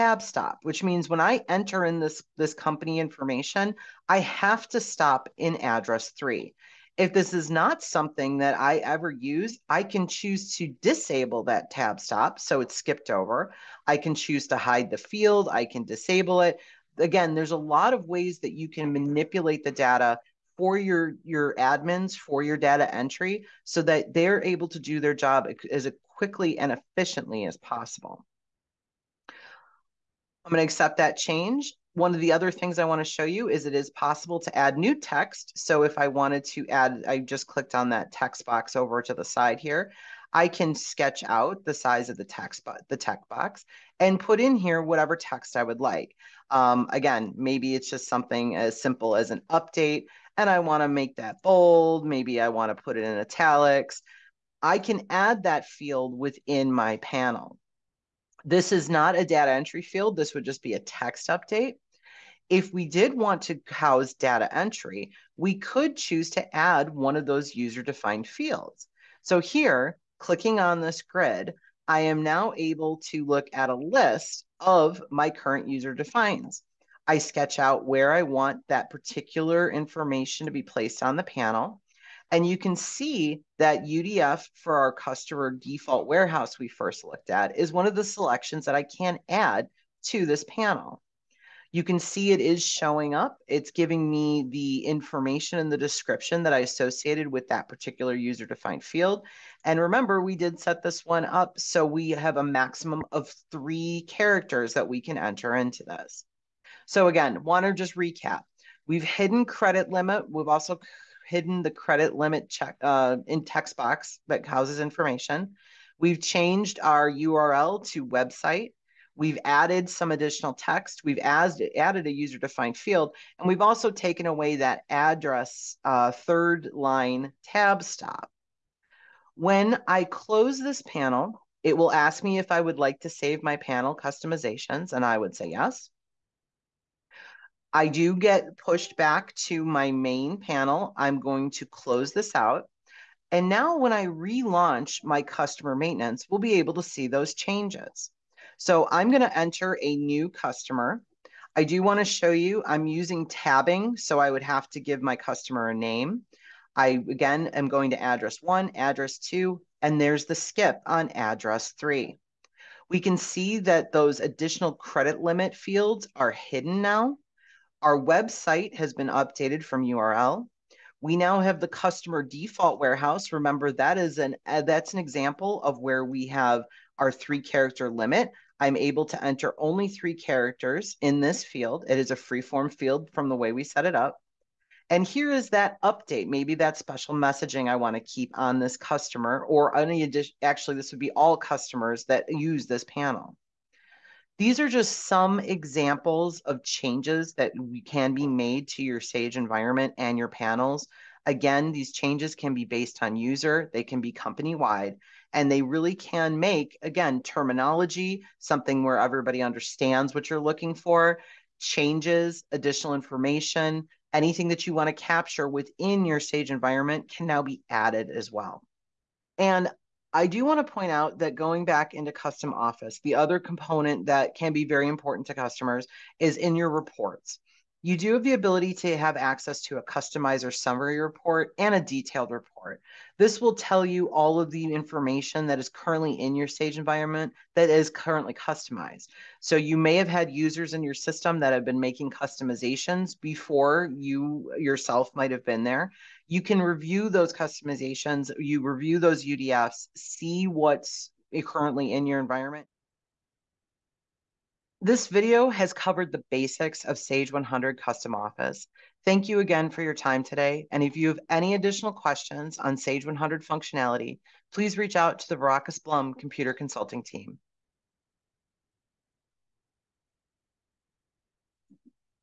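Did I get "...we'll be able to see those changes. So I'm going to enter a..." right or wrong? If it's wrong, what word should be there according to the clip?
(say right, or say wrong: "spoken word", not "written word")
right.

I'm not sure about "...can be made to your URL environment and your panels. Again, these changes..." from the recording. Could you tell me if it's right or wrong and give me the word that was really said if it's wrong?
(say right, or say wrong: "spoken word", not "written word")
wrong: "Sage", not "URL".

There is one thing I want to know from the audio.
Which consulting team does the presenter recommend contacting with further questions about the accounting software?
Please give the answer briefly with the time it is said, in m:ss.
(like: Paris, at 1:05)
Vrakas Blum Computer Consulting, at 4:25.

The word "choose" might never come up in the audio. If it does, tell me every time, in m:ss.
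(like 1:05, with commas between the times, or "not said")
0:10, 0:14, 1:05.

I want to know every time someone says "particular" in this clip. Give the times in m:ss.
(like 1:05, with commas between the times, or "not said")
1:18, 1:37.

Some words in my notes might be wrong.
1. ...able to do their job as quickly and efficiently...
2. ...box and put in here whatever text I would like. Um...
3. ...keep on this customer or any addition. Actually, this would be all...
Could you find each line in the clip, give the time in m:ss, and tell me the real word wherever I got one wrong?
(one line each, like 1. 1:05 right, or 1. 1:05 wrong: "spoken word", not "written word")
1. 0:24 right
2. 0:43 right
3. 3:08 right.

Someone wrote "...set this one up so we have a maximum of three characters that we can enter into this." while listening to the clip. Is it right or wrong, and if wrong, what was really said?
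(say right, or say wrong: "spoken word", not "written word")
right.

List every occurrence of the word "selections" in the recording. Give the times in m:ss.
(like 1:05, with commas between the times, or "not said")
1:28.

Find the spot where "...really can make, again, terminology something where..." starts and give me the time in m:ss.
3:25.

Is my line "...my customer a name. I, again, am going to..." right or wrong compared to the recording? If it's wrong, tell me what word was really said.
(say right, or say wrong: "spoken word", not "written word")
right.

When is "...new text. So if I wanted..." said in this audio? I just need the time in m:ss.
0:34.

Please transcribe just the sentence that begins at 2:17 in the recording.
I do get pushed back to my main panel.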